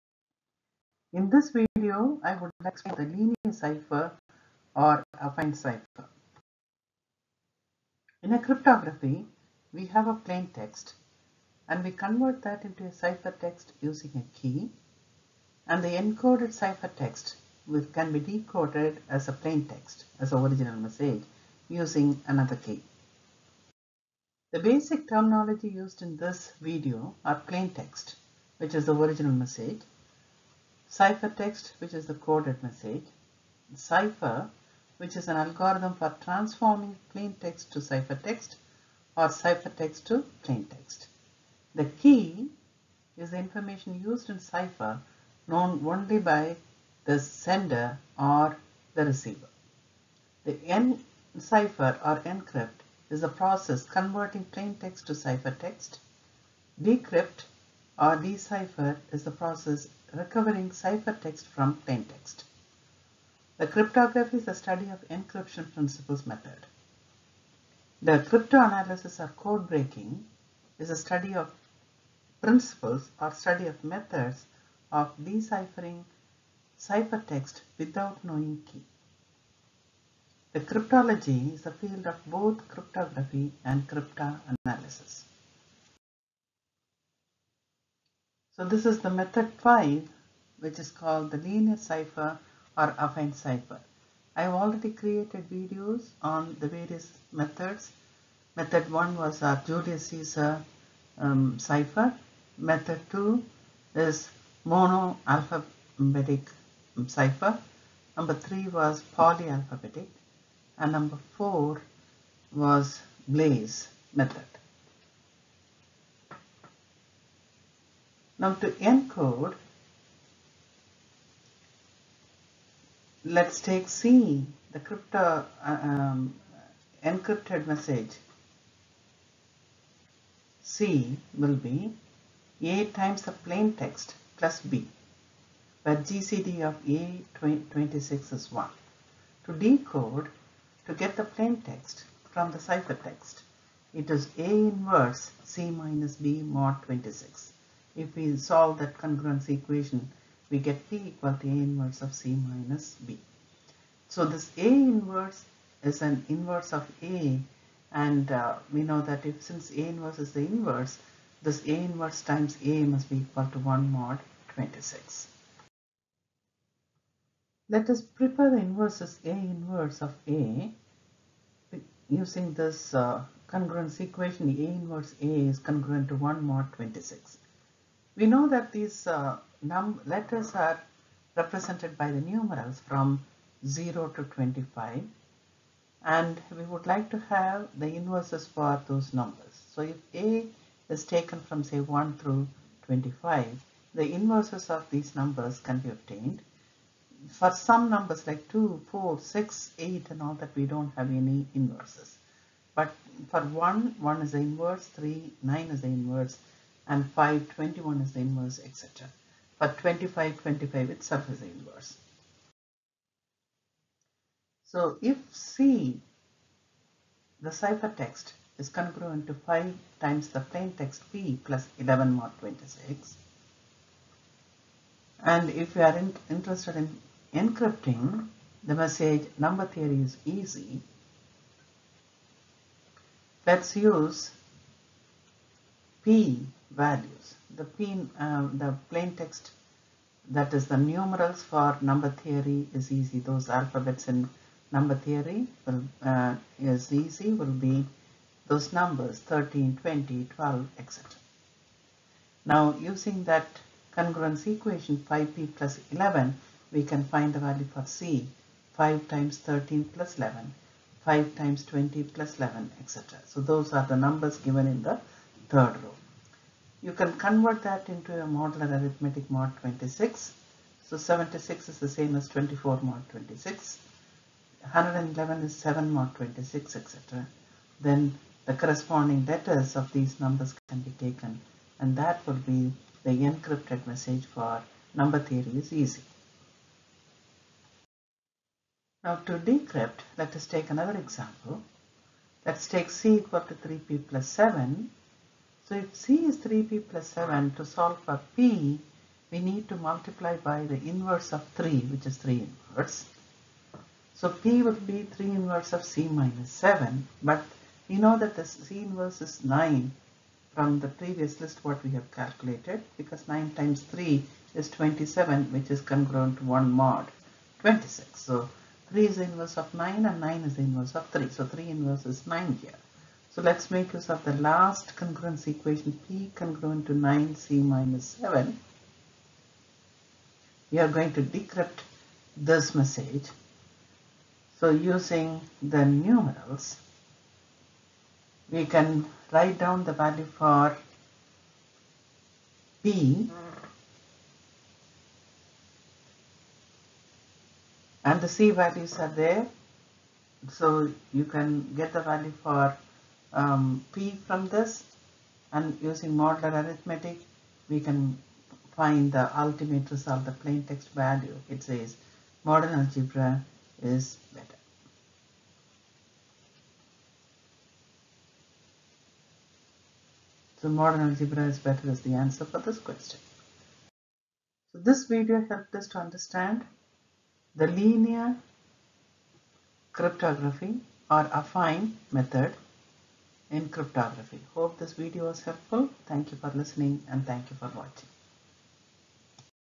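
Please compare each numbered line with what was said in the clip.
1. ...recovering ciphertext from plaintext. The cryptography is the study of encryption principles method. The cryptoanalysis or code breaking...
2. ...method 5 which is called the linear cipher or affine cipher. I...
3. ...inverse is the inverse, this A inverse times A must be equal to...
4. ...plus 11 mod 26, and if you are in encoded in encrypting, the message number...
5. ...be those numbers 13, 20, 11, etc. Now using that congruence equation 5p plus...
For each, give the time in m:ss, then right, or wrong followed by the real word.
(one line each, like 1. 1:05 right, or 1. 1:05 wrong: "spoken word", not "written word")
1. 1:00 right
2. 1:29 right
3. 2:39 right
4. 3:41 wrong: "interested", not "encoded"
5. 4:07 wrong: "12", not "11".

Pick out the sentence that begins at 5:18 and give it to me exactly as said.
So 3 is inverse of 9 and 9 is inverse of 3.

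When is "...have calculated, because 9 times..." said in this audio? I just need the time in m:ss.
5:11.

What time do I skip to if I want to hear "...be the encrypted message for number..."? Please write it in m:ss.
4:42.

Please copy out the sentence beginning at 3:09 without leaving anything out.
So if A is taken from say 1 through 25, the inverses of these numbers can be obtained.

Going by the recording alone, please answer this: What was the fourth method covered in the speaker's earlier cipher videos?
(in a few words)
Blaise method.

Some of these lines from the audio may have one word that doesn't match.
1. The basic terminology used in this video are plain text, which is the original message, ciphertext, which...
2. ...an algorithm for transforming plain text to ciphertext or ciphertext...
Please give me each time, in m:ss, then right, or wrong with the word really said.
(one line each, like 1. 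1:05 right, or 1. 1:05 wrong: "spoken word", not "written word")
1. 0:24 right
2. 0:35 right.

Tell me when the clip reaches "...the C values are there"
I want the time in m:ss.
5:48.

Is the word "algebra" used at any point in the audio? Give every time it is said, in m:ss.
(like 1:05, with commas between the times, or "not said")
6:02, 6:11.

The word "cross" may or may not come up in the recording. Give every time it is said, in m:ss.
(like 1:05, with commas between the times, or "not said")
not said.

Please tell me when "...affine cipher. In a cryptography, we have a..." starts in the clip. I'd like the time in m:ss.
0:05.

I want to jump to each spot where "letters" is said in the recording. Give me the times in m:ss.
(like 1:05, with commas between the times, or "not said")
2:59, 4:39.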